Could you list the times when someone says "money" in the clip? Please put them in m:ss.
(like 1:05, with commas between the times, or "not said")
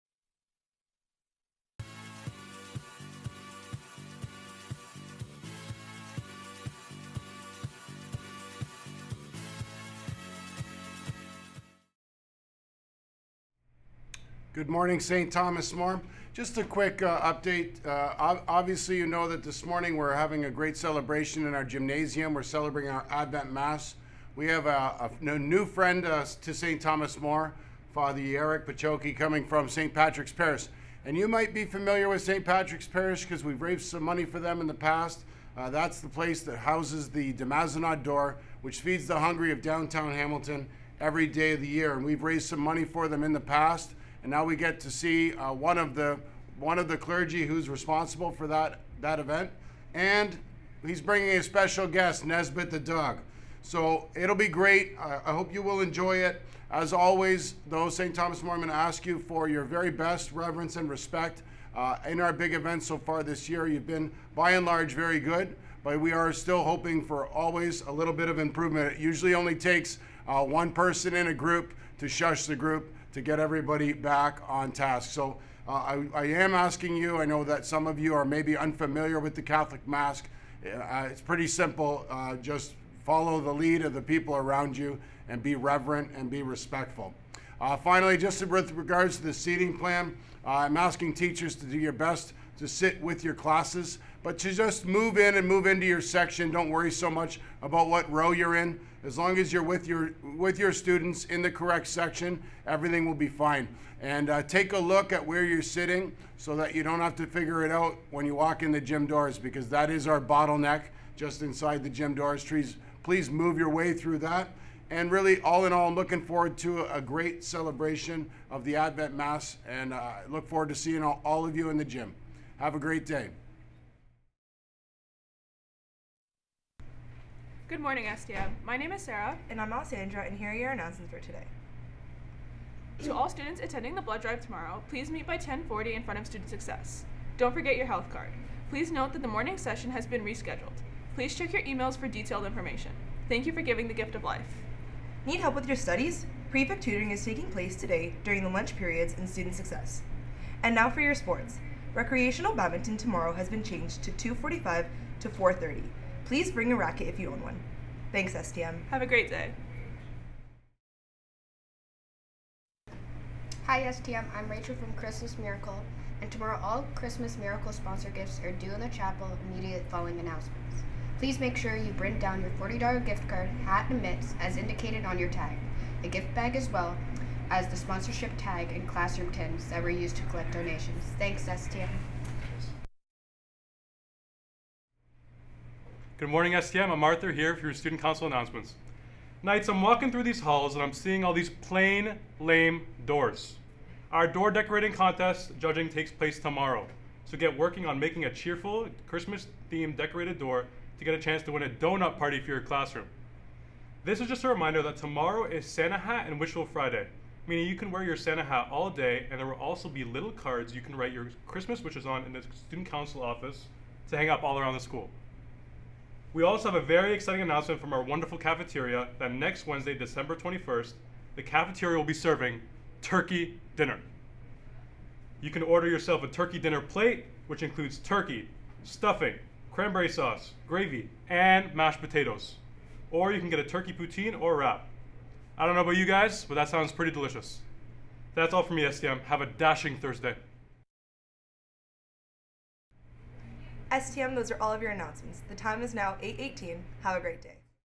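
0:34, 0:42.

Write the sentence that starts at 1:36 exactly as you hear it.
Don't worry so much about what row you're in.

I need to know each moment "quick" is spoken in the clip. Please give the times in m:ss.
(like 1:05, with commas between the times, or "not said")
0:16.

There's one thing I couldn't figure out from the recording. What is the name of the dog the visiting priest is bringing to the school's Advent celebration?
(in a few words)
Nesbitt.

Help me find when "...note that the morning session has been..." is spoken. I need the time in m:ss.
2:18.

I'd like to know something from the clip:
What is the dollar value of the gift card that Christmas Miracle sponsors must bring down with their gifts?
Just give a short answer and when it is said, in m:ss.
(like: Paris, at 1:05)
$40, at 2:52.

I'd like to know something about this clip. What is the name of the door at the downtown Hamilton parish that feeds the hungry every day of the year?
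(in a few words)
de Mazenod Door.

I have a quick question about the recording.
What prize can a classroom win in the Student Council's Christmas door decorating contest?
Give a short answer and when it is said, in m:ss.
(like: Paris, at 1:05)
A donut party, at 3:21.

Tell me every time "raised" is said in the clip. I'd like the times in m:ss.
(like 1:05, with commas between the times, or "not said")
0:33, 0:42.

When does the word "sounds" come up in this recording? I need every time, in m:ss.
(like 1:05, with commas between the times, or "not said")
3:56.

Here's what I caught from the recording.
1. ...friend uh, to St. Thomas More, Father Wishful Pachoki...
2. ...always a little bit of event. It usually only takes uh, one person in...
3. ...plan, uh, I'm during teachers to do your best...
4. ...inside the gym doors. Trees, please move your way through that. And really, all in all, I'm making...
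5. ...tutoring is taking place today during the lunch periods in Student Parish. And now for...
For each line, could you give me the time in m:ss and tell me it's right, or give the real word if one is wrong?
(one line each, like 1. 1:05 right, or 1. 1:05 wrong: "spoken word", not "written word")
1. 0:25 wrong: "Eric", not "Wishful"
2. 1:07 wrong: "improvement", not "event"
3. 1:29 wrong: "asking", not "during"
4. 1:51 wrong: "looking", not "making"
5. 2:26 wrong: "Success", not "Parish".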